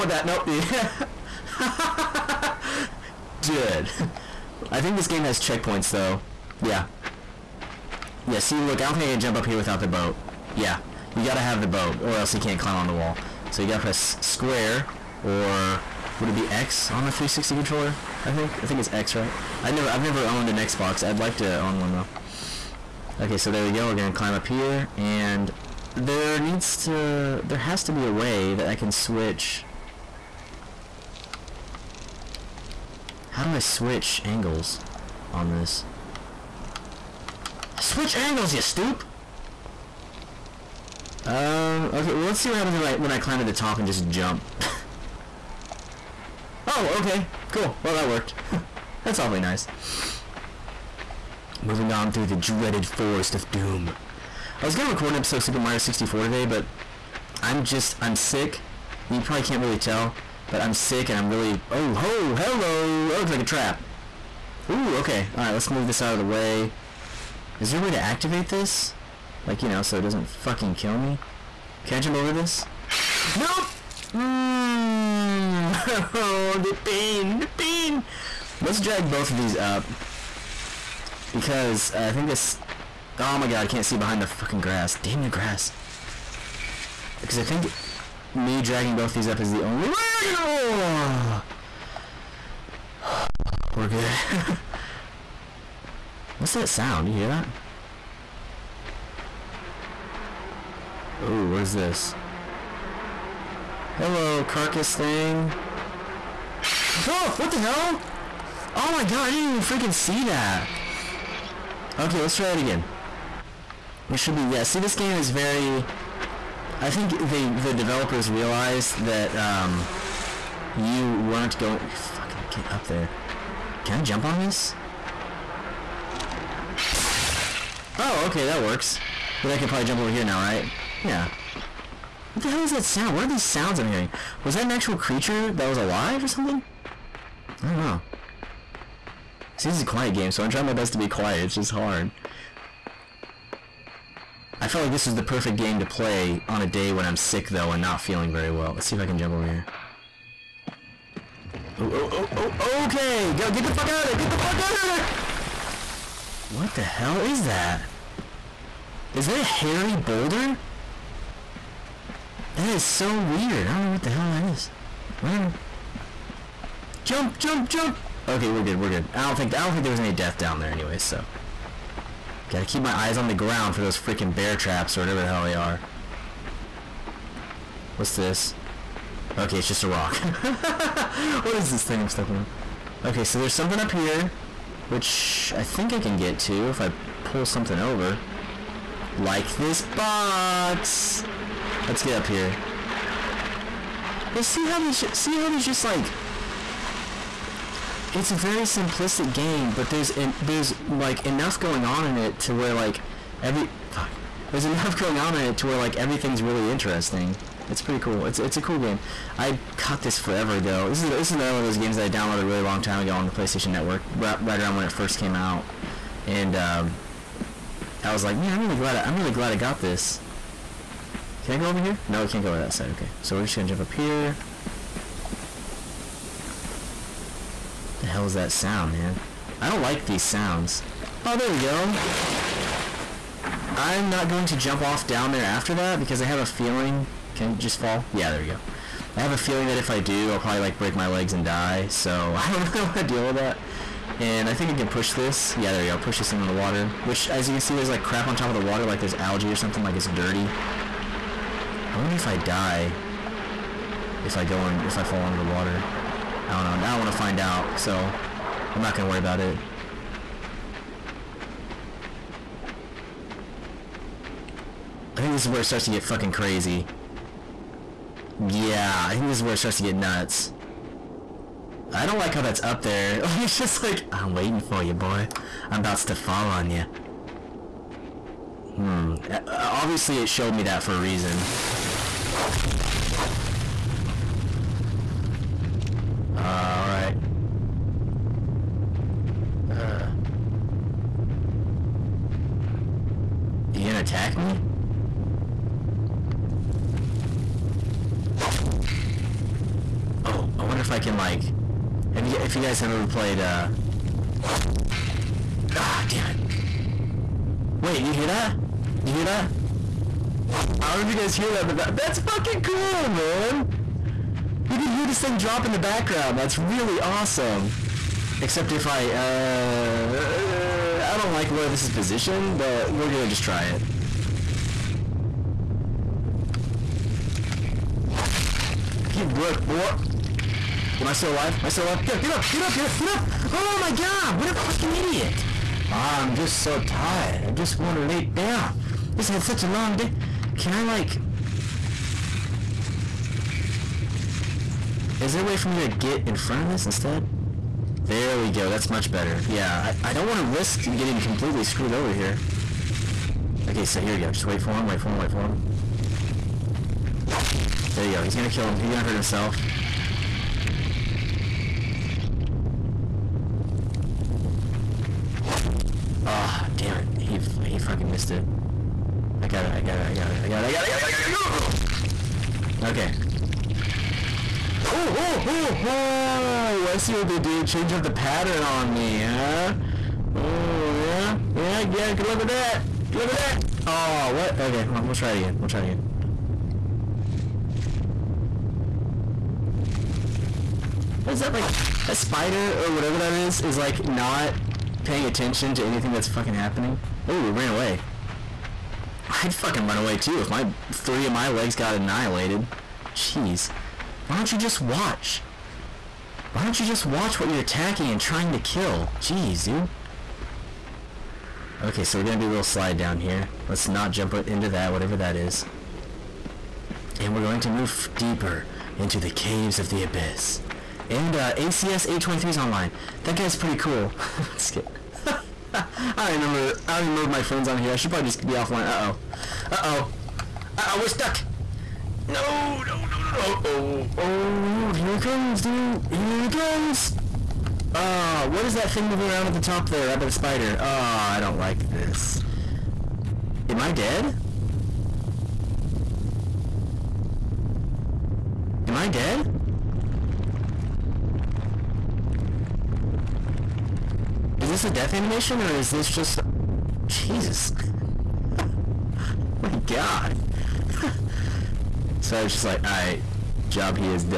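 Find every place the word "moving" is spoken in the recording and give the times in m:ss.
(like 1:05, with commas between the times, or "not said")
0:51, 7:19.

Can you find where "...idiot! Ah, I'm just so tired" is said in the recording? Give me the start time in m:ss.
5:34.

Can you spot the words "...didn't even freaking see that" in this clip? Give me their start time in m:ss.
1:49.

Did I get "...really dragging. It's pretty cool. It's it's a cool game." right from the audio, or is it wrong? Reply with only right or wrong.
wrong.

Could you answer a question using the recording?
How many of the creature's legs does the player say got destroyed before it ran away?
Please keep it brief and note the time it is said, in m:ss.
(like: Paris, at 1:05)
3, at 6:40.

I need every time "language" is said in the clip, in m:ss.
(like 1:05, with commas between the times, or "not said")
not said.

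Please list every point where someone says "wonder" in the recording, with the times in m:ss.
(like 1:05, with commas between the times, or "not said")
4:11, 5:00.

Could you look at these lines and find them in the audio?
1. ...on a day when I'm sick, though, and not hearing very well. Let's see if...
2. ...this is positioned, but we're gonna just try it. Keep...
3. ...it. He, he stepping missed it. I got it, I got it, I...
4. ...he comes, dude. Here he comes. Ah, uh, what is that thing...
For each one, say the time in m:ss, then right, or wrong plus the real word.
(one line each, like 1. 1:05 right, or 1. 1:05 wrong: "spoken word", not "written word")
1. 2:26 wrong: "feeling", not "hearing"
2. 5:21 right
3. 6:06 wrong: "fucking", not "stepping"
4. 7:15 right.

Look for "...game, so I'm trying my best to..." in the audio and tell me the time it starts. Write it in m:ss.
2:20.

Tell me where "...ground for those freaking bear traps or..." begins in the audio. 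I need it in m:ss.
2:53.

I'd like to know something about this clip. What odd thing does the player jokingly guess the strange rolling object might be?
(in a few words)
A hairy boulder.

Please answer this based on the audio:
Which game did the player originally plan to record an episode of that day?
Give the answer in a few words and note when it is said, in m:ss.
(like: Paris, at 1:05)
Super Mario 64, at 0:55.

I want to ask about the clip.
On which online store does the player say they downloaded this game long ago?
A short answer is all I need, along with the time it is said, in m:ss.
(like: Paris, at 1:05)
PlayStation Network, at 3:33.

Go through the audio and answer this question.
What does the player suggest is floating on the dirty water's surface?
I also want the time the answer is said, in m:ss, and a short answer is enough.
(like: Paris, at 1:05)
Algae, at 4:09.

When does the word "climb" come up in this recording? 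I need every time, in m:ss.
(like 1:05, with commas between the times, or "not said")
0:12, 0:24, 0:43.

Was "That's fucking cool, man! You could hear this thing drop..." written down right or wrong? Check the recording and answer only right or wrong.
right.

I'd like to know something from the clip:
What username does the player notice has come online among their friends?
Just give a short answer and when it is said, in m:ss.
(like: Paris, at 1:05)
ACS 823, at 7:01.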